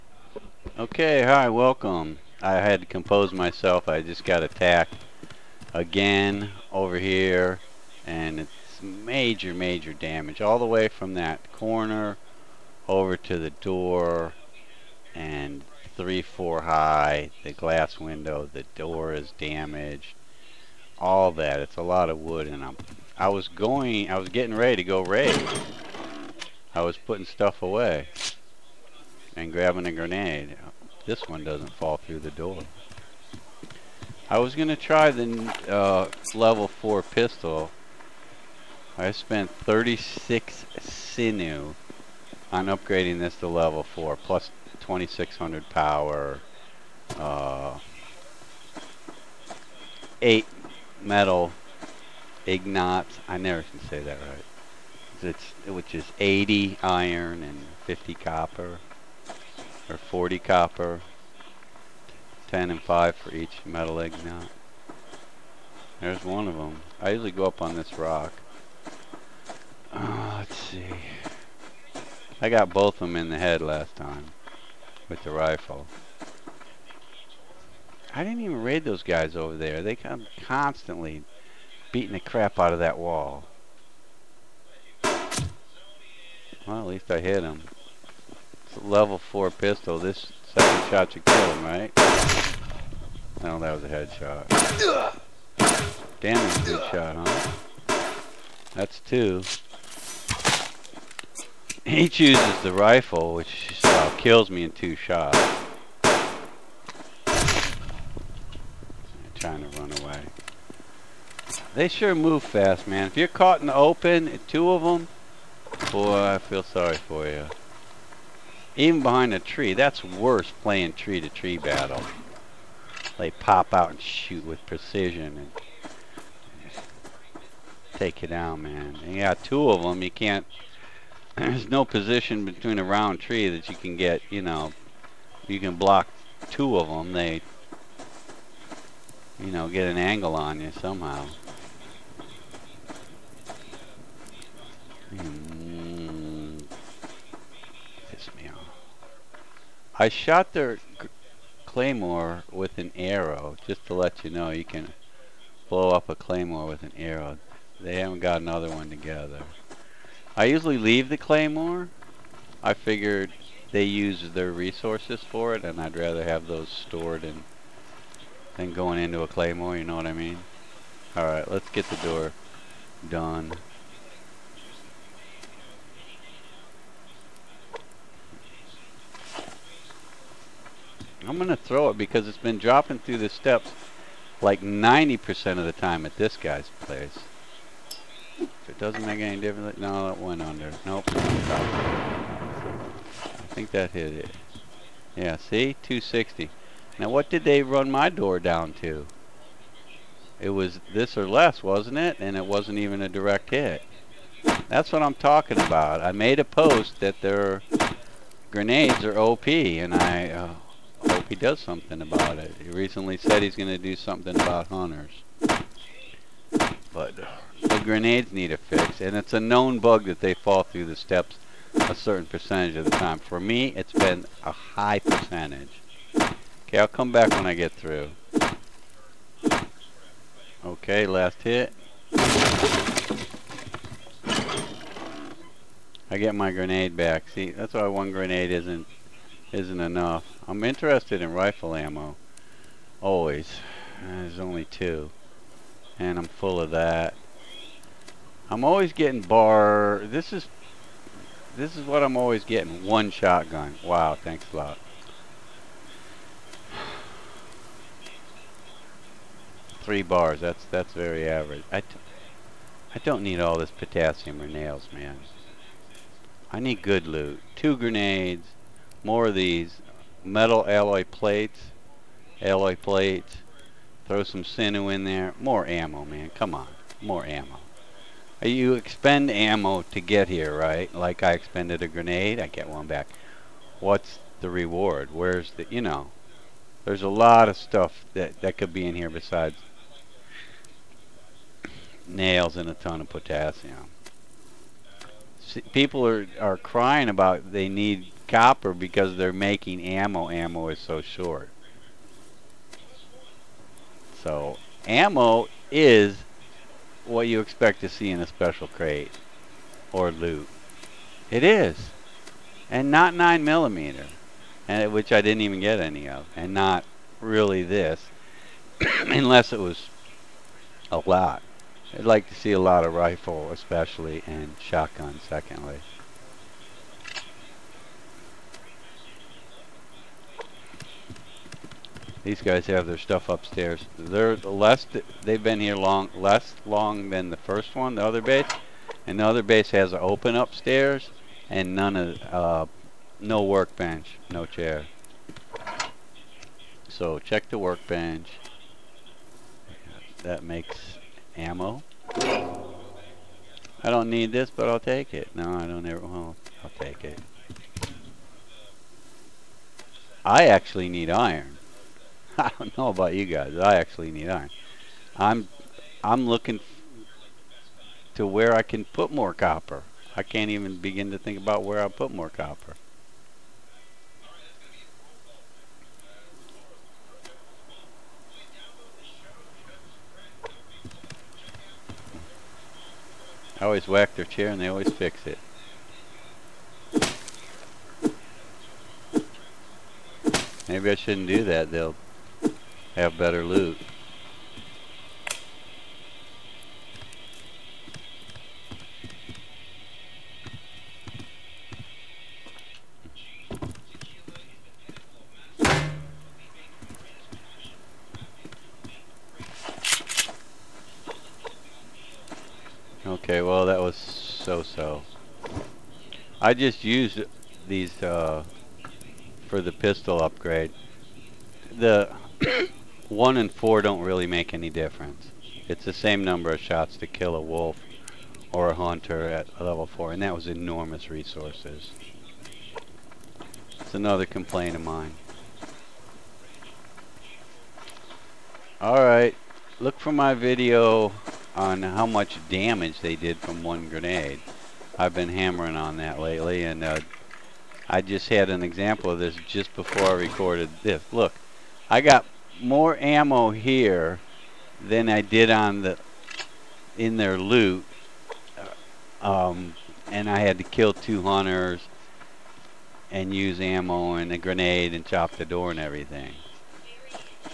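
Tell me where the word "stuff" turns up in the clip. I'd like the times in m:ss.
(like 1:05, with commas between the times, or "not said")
0:27, 4:47, 5:32.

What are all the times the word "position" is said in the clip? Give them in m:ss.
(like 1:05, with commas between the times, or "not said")
2:11.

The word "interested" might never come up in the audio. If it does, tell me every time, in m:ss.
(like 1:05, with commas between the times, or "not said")
4:00.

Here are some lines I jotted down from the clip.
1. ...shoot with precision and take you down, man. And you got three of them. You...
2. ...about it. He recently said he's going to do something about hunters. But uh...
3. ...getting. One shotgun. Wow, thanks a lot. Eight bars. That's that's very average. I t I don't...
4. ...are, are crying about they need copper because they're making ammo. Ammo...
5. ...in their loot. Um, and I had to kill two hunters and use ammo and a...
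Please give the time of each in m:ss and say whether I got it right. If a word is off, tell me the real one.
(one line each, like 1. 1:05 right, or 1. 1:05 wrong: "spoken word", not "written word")
1. 2:04 wrong: "two", not "three"
2. 3:32 right
3. 4:12 wrong: "Three", not "Eight"
4. 4:56 right
5. 7:36 right.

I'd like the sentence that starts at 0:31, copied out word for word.
This one doesn't fall through the door.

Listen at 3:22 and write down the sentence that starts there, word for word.
And it wasn't even a direct hit.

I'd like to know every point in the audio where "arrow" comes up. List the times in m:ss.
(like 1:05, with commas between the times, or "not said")
2:32, 2:36.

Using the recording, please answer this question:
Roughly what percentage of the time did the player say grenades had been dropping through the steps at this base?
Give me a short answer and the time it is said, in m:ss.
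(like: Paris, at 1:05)
90%, at 3:04.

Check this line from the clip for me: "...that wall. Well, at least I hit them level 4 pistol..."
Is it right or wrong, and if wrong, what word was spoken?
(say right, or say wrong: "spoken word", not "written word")
right.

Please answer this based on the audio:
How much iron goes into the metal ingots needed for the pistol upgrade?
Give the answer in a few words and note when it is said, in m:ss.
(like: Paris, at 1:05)
80, at 0:56.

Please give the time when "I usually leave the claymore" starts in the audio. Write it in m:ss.
2:40.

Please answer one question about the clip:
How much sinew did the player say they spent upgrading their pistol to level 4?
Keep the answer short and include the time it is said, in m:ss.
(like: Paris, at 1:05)
36, at 0:39.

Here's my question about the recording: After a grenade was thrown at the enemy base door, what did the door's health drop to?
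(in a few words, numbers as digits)
260.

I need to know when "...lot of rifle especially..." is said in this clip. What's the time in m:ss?
5:22.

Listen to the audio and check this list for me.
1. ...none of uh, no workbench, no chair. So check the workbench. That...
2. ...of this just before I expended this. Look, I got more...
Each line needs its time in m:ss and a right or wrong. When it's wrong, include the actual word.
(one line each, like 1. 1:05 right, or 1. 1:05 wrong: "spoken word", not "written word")
1. 5:41 right
2. 7:29 wrong: "recorded", not "expended".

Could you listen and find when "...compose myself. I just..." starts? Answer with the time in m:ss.
0:02.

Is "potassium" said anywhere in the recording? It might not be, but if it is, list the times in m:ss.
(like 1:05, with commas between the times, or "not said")
4:23, 4:53.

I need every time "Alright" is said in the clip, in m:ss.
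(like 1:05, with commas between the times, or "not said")
2:51, 7:18.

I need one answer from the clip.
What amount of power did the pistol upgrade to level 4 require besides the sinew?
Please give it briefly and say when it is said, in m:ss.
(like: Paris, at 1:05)
2600, at 0:44.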